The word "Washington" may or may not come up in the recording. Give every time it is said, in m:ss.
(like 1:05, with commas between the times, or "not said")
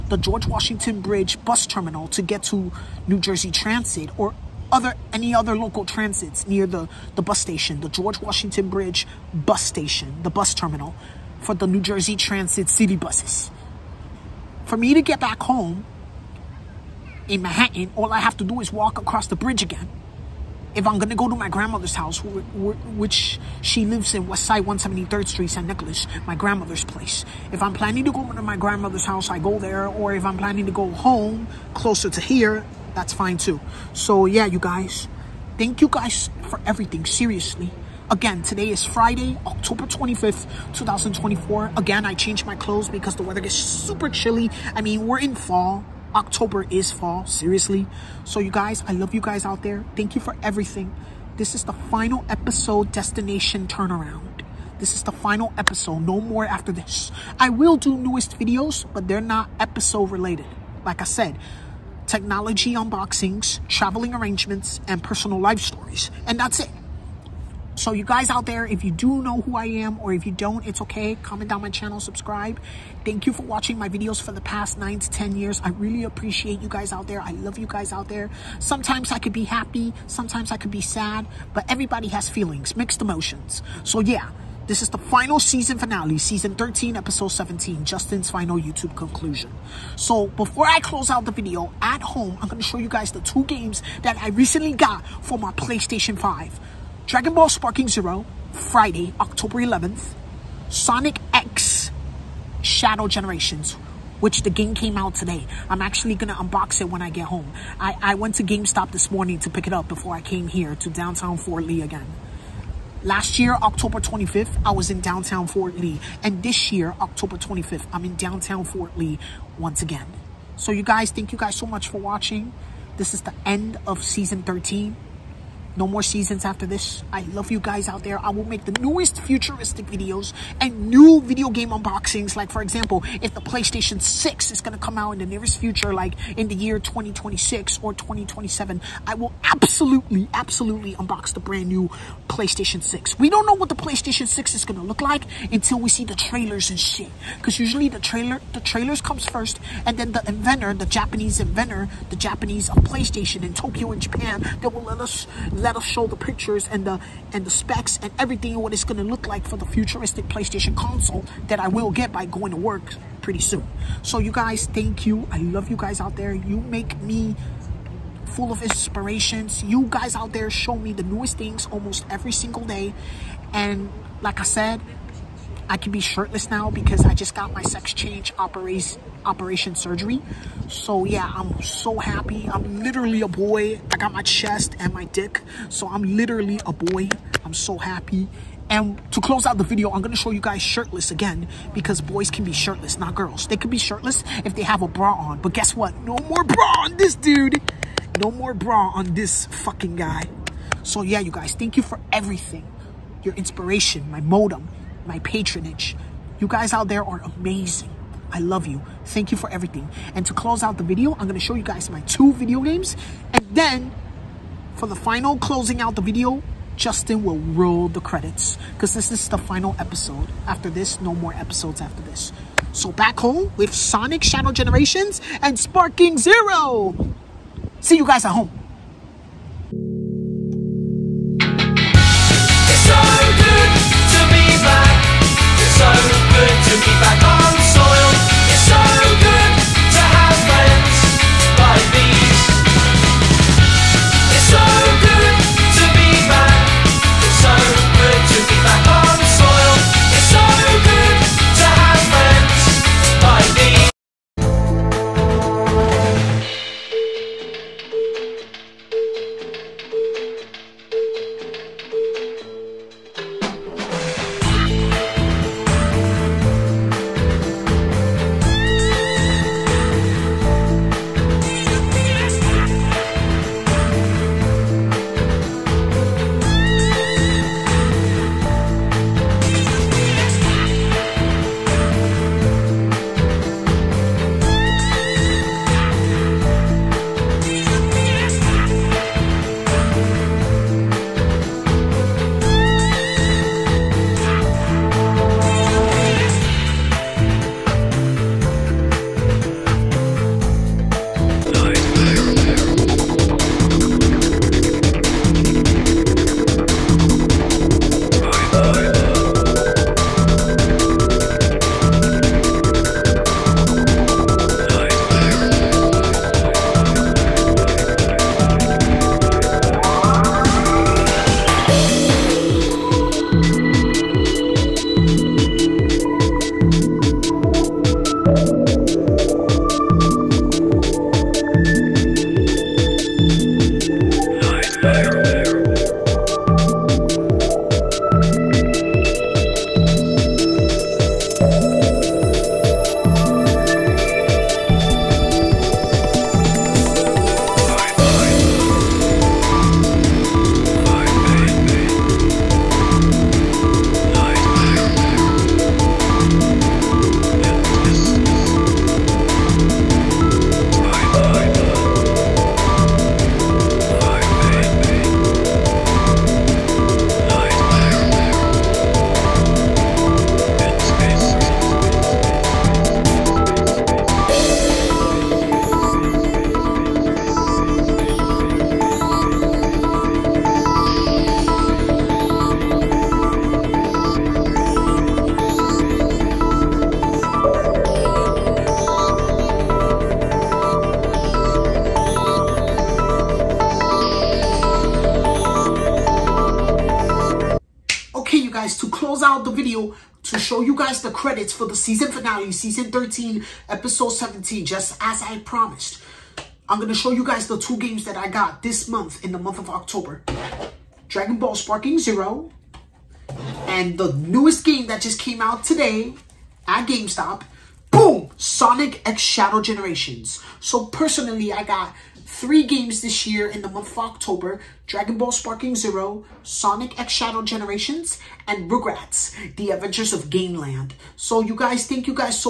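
0:00, 0:08.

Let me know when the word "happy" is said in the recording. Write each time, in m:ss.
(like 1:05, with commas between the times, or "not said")
1:19, 3:01, 3:07.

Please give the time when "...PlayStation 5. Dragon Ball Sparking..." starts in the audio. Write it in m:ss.
1:35.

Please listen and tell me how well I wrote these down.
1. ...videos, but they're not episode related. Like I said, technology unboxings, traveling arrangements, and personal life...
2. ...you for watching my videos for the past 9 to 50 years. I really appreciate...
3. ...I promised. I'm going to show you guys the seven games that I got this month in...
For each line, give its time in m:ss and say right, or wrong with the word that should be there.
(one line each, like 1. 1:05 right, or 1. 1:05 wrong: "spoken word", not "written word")
1. 0:58 right
2. 1:13 wrong: "10", not "50"
3. 6:45 wrong: "two", not "seven".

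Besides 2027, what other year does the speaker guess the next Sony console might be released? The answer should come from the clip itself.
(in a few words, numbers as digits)
2026.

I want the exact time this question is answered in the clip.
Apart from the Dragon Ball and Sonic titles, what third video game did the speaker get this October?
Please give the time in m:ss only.
7:08.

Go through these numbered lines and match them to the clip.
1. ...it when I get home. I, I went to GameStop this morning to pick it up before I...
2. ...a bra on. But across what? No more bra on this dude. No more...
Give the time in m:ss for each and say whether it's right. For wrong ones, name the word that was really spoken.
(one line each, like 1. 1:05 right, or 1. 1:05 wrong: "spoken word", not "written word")
1. 1:46 right
2. 3:14 wrong: "guess", not "across".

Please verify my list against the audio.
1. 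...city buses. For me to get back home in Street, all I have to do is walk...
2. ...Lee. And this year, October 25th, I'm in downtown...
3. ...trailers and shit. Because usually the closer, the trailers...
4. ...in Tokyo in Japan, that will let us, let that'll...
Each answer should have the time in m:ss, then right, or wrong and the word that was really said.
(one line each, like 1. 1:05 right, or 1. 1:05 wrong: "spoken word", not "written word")
1. 0:12 wrong: "Manhattan", not "Street"
2. 1:55 right
3. 2:26 wrong: "trailer", not "closer"
4. 2:33 right.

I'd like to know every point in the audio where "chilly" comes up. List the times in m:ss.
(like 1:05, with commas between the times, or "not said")
0:44.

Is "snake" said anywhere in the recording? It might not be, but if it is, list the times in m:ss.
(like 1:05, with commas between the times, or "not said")
not said.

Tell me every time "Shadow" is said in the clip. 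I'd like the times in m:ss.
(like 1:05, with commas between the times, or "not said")
1:42, 3:44, 6:59, 7:07.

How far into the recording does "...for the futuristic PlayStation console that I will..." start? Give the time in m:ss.
2:39.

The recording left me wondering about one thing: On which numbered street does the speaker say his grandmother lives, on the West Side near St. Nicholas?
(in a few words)
173rd Street.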